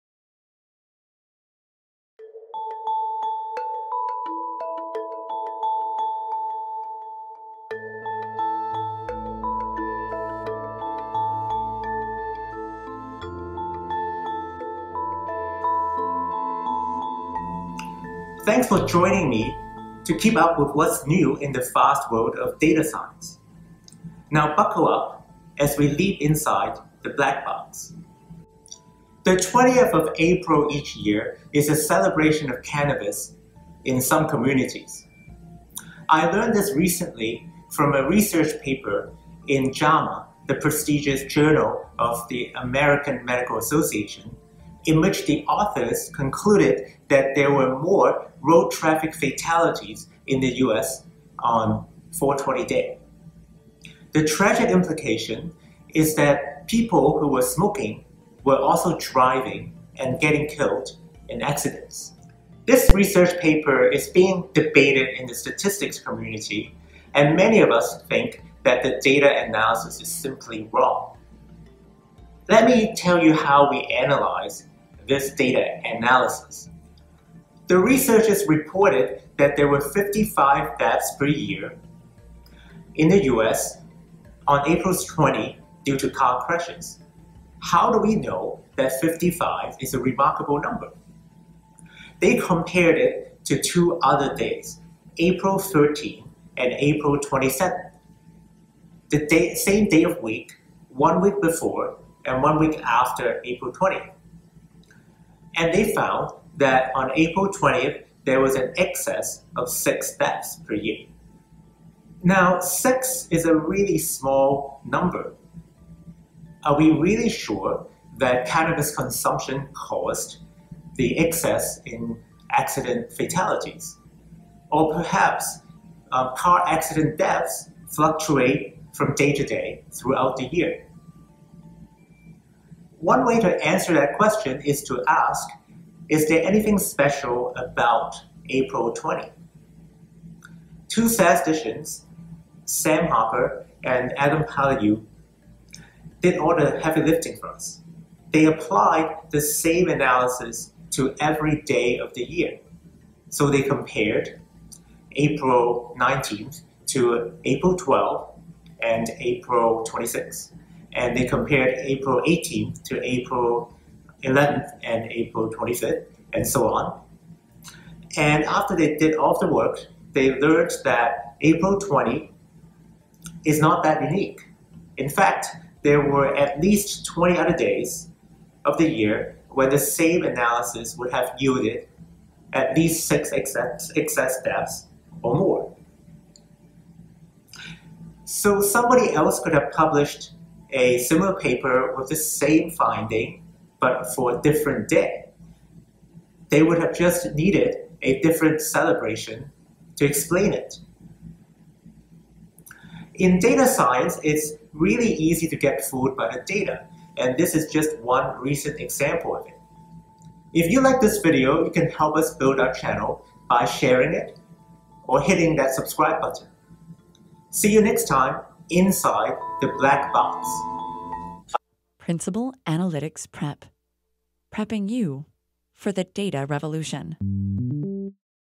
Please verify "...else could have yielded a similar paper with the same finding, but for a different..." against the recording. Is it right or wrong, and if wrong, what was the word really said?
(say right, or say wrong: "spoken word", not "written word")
wrong: "published", not "yielded".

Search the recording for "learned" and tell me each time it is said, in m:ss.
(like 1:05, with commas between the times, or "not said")
0:36, 2:50.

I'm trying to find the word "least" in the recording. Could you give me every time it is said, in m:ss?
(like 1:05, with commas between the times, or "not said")
2:56, 3:02.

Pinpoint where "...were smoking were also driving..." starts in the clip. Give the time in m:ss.
0:57.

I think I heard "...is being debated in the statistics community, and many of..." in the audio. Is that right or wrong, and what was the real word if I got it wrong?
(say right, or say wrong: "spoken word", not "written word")
right.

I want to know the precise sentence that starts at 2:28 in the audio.
They applied the same analysis to every day of the year.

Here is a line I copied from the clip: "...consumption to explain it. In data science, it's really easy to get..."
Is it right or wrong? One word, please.
wrong.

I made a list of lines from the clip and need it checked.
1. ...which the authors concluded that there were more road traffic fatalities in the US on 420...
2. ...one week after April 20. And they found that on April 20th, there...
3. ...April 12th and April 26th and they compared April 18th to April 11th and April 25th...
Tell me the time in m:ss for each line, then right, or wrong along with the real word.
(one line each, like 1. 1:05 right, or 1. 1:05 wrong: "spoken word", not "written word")
1. 0:44 right
2. 1:42 right
3. 2:37 right.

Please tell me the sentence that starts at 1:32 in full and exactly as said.
They compared it to two other days, April 13 and April 27.